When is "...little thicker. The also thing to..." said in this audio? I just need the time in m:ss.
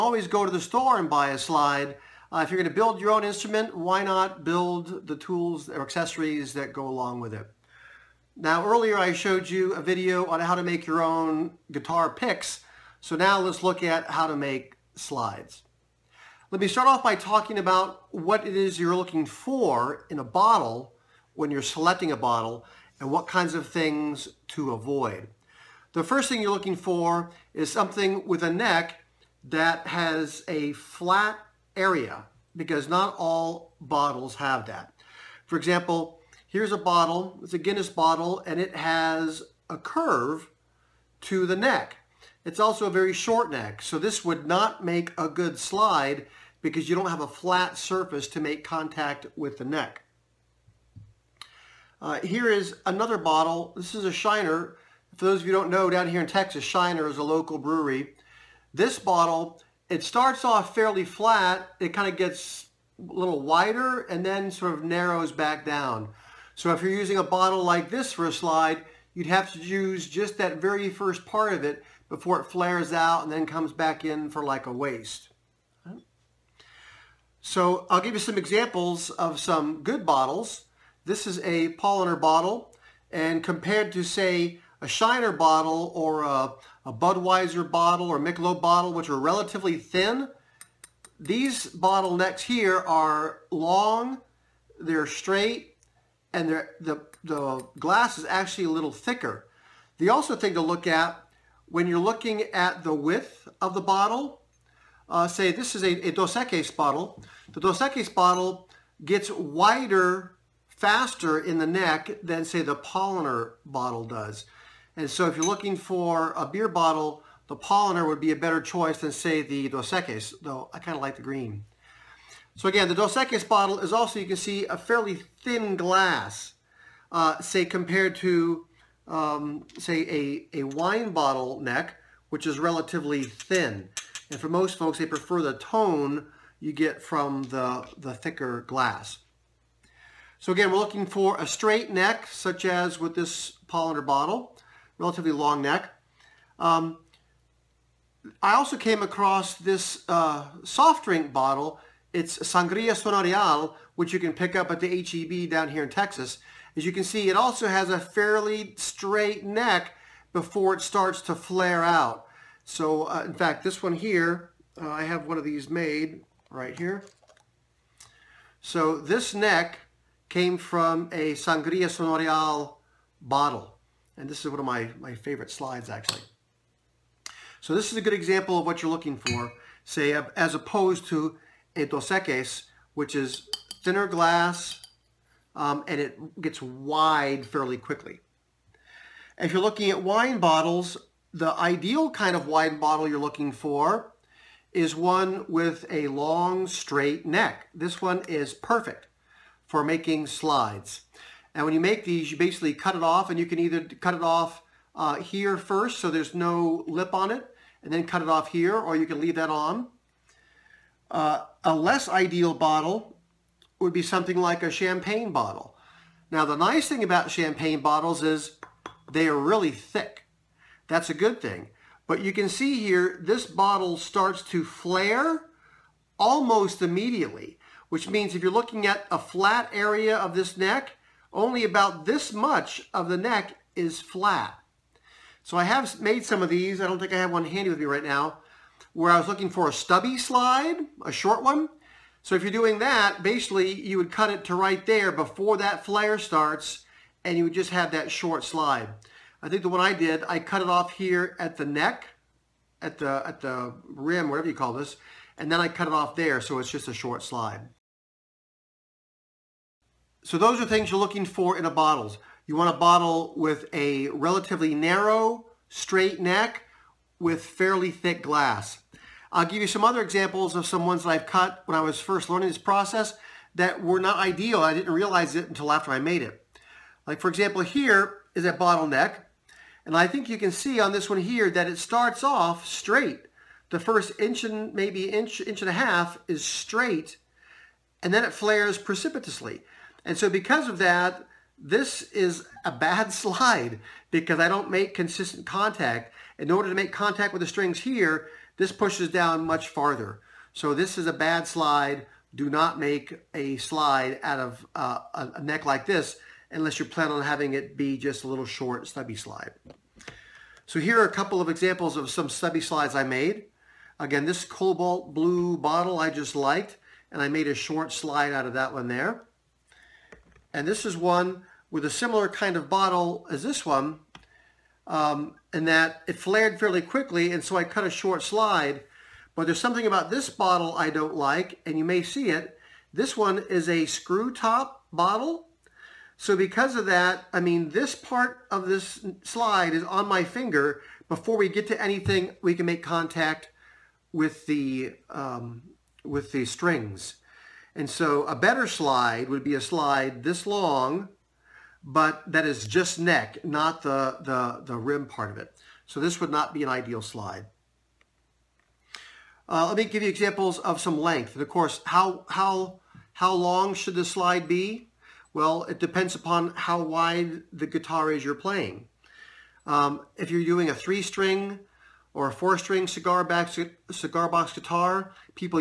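1:38.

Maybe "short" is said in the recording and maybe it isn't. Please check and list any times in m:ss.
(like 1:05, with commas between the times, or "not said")
0:43, 4:01, 4:08, 4:16, 5:08, 5:17, 5:27.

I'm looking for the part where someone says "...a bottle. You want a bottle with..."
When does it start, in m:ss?
4:21.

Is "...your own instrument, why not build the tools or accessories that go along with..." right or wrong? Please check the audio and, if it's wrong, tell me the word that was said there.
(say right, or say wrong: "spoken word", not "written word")
right.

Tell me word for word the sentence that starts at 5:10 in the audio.
So here are a couple of examples of some stubby slides I made.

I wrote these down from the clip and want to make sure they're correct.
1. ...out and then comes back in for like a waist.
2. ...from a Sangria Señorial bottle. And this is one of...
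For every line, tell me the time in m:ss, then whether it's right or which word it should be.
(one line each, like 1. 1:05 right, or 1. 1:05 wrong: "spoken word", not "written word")
1. 1:12 right
2. 2:50 right.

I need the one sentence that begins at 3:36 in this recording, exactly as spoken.
Now the nice thing about champagne bottles is they are really thick.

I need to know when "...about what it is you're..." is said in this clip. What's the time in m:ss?
0:17.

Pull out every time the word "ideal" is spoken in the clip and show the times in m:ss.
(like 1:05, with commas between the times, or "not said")
3:11, 3:32, 4:34, 5:56.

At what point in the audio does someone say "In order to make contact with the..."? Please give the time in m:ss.
4:56.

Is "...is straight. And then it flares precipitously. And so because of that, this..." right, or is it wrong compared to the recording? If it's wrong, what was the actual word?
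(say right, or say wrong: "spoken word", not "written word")
right.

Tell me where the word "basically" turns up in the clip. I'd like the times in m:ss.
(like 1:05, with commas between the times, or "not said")
3:22, 4:03.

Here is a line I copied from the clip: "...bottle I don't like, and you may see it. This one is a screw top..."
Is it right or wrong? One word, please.
right.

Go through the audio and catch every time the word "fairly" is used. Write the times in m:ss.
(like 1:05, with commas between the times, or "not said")
1:00, 2:04, 2:37, 3:07, 4:27, 5:26.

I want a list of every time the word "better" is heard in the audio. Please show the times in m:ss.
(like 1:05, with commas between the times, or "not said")
1:58, 5:48.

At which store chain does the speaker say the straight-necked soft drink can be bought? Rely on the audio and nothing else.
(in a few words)
HEB.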